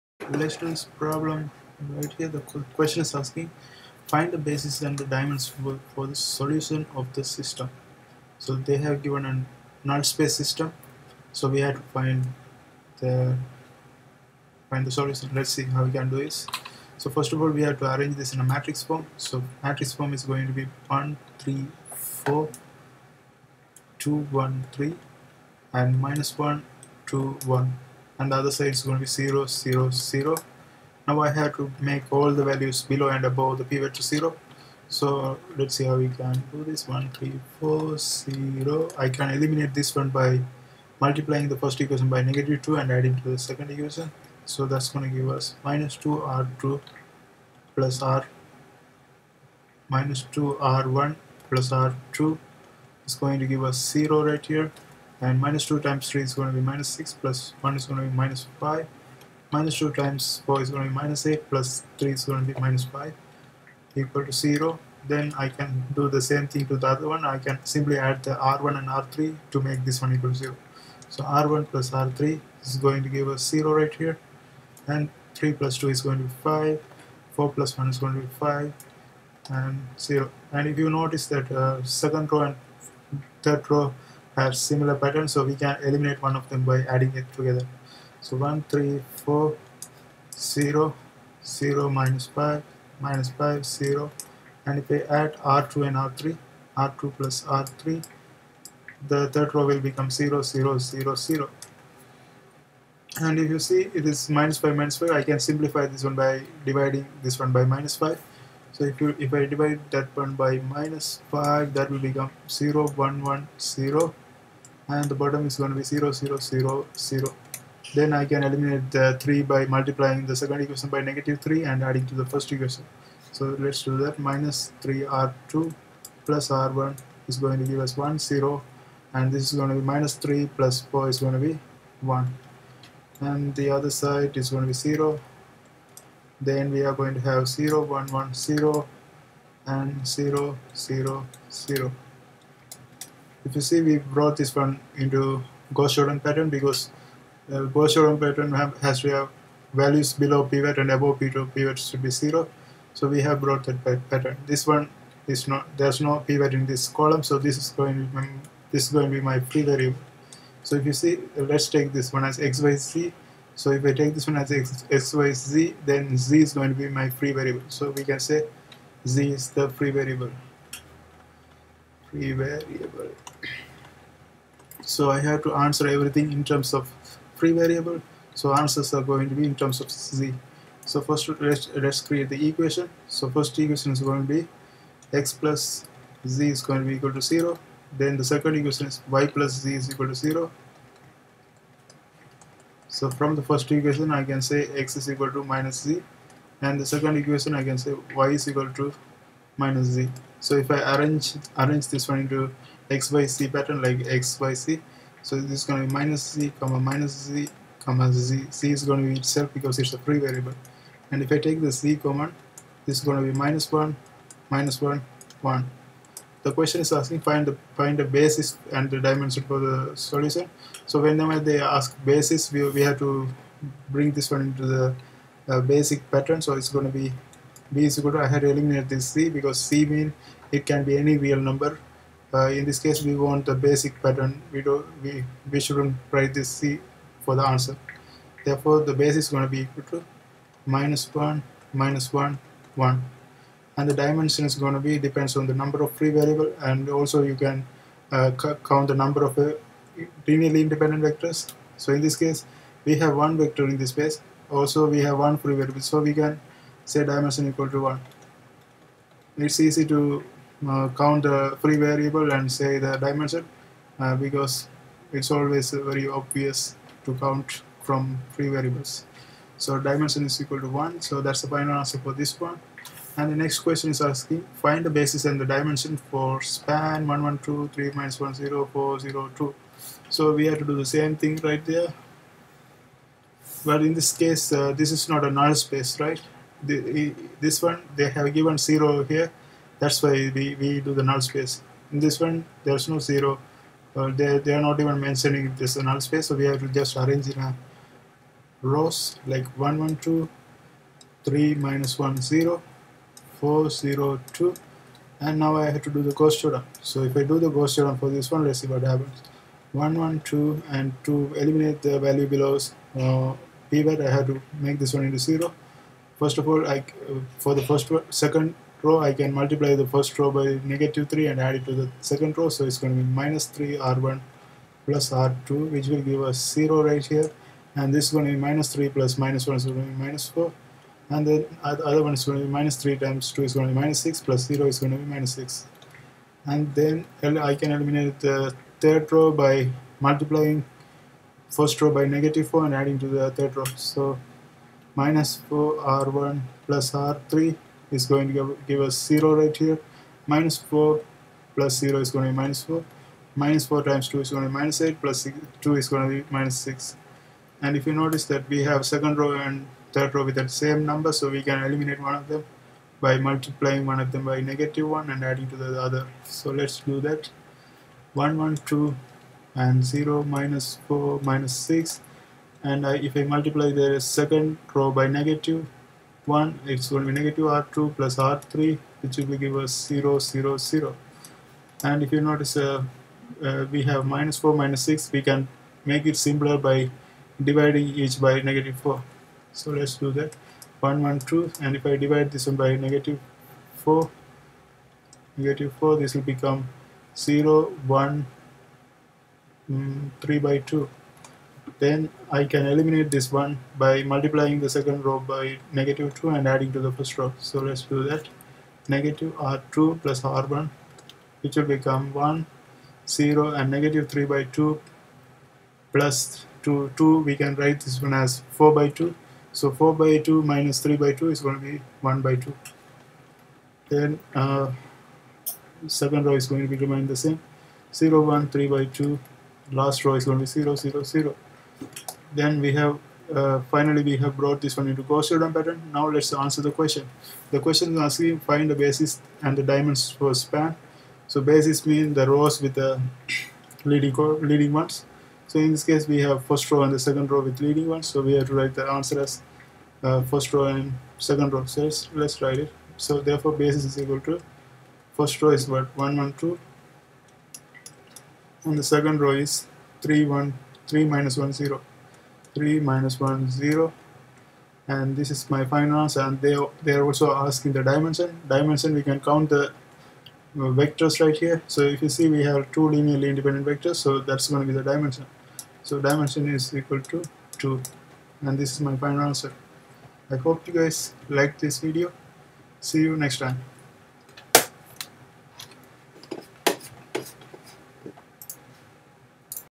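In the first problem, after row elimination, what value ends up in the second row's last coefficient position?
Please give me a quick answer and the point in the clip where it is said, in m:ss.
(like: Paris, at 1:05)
-5, at 1:02.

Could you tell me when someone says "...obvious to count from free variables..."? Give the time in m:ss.
4:26.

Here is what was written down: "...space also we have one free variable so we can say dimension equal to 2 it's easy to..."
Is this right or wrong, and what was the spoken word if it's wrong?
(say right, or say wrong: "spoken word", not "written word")
wrong: "1", not "2".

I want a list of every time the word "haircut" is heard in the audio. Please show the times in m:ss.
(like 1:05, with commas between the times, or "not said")
not said.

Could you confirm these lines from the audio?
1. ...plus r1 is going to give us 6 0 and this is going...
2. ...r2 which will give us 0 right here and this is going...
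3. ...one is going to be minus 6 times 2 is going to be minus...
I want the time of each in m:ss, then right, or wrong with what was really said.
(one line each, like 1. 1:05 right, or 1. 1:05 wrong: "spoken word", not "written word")
1. 2:06 wrong: "1", not "6"
2. 5:25 right
3. 5:32 wrong: "3", not "6".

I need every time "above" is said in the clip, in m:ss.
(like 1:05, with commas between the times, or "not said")
0:33, 2:30.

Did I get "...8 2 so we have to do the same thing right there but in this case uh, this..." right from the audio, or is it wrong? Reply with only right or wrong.
wrong.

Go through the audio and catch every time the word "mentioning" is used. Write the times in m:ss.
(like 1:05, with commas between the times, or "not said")
4:54.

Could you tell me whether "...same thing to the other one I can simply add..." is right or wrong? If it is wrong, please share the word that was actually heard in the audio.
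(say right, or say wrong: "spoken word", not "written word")
right.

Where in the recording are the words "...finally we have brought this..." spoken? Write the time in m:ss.
7:13.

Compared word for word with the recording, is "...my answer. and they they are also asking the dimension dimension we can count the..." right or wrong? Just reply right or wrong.
right.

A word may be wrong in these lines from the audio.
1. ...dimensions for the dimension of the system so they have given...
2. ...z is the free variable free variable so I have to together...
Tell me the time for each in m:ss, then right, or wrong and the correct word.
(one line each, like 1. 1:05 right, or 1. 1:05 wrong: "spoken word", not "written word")
1. 0:05 wrong: "solution", not "dimension"
2. 2:49 wrong: "answer", not "together".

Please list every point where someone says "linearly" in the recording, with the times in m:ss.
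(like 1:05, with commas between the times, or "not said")
4:10, 7:52.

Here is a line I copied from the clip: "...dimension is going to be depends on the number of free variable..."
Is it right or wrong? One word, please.
right.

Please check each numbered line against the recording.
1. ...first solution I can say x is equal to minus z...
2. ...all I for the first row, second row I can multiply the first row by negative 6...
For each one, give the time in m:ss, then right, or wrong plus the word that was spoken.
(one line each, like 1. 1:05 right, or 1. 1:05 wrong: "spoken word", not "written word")
1. 3:13 wrong: "equation", not "solution"
2. 5:16 wrong: "3", not "6".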